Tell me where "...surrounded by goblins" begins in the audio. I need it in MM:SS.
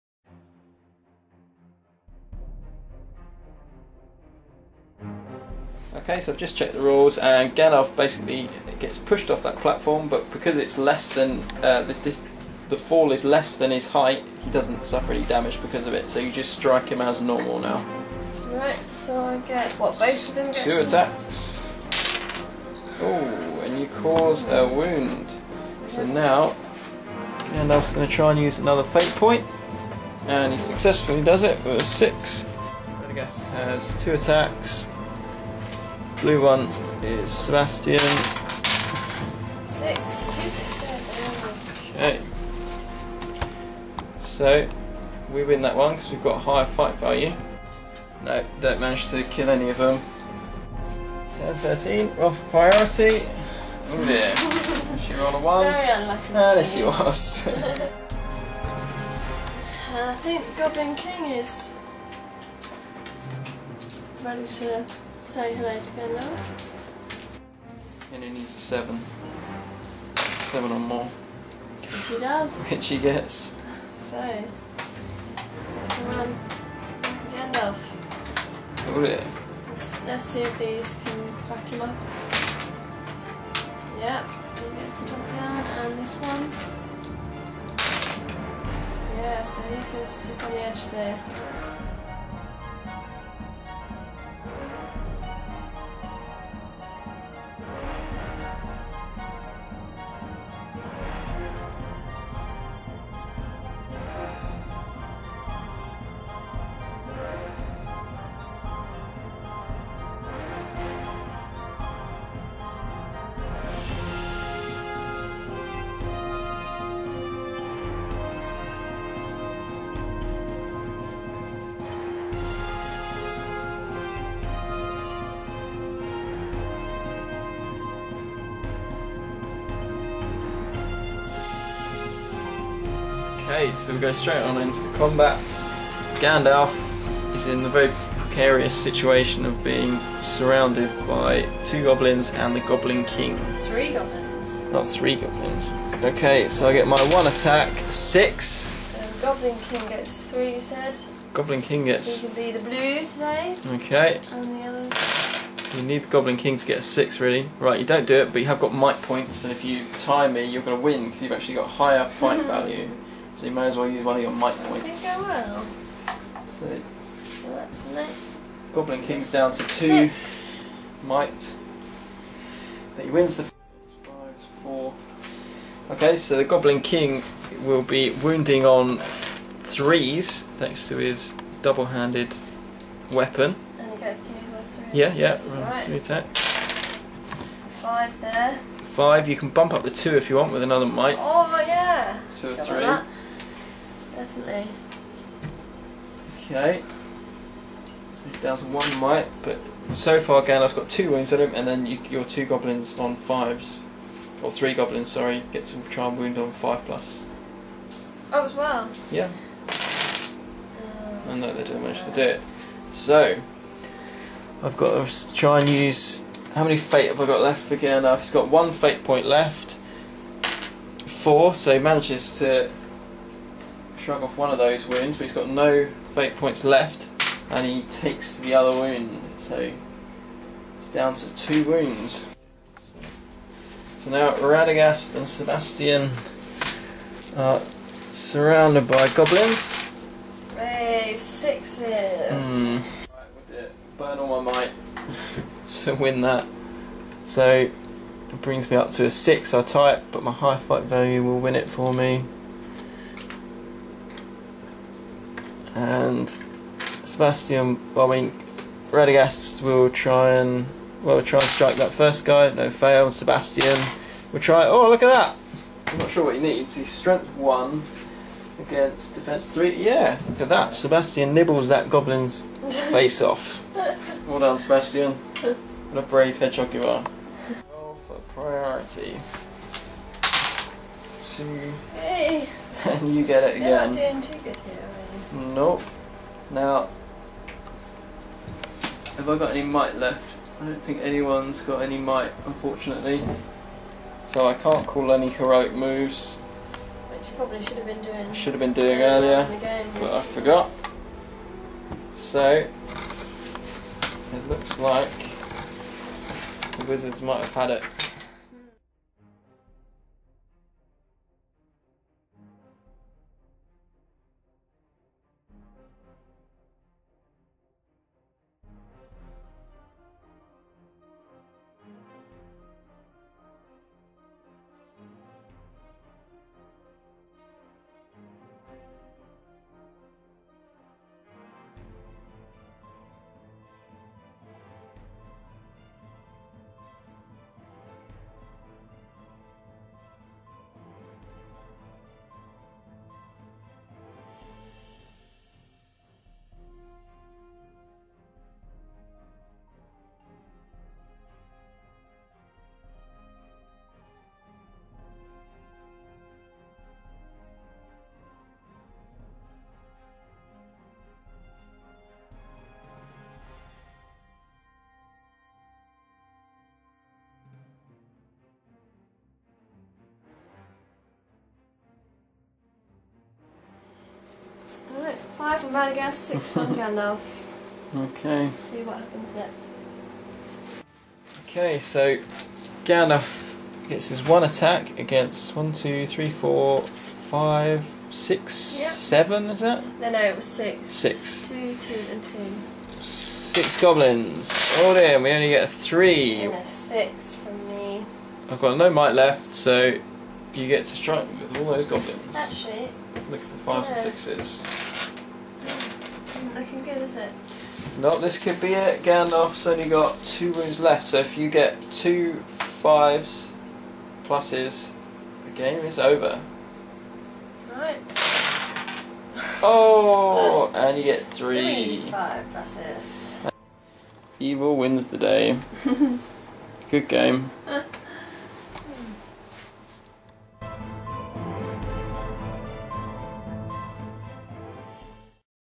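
03:57.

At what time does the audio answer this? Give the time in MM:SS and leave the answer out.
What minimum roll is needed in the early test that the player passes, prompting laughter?
01:10.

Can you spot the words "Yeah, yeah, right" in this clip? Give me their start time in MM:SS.
03:04.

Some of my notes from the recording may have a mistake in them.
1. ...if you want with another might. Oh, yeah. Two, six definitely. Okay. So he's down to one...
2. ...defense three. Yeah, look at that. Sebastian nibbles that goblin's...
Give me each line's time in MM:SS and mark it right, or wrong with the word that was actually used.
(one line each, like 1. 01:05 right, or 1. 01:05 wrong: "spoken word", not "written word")
1. 03:10 wrong: "three", not "six"
2. 04:29 right.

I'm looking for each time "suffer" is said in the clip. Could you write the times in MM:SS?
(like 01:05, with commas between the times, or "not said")
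00:14.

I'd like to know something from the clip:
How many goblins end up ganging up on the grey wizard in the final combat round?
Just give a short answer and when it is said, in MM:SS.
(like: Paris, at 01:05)
6, at 06:32.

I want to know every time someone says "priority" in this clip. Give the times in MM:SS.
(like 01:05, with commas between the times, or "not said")
00:52, 04:38.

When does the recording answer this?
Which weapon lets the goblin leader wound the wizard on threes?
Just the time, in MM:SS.
03:01.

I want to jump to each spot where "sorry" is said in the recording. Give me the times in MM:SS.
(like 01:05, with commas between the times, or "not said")
01:05, 03:25.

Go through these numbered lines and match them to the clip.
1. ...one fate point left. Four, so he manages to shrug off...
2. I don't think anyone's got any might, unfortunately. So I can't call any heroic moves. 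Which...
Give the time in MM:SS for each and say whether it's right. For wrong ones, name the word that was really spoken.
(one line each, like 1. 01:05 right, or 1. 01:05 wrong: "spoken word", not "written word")
1. 03:38 right
2. 04:50 right.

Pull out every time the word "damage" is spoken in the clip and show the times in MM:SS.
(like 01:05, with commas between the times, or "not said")
00:15.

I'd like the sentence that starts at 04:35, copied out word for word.
What a brave hedgehog you are.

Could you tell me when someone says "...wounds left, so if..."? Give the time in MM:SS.
06:50.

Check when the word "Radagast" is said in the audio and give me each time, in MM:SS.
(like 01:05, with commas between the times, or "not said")
03:54, 04:18.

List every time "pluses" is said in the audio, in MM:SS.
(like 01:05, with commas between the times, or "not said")
06:54, 07:02.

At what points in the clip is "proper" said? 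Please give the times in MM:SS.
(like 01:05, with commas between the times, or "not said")
not said.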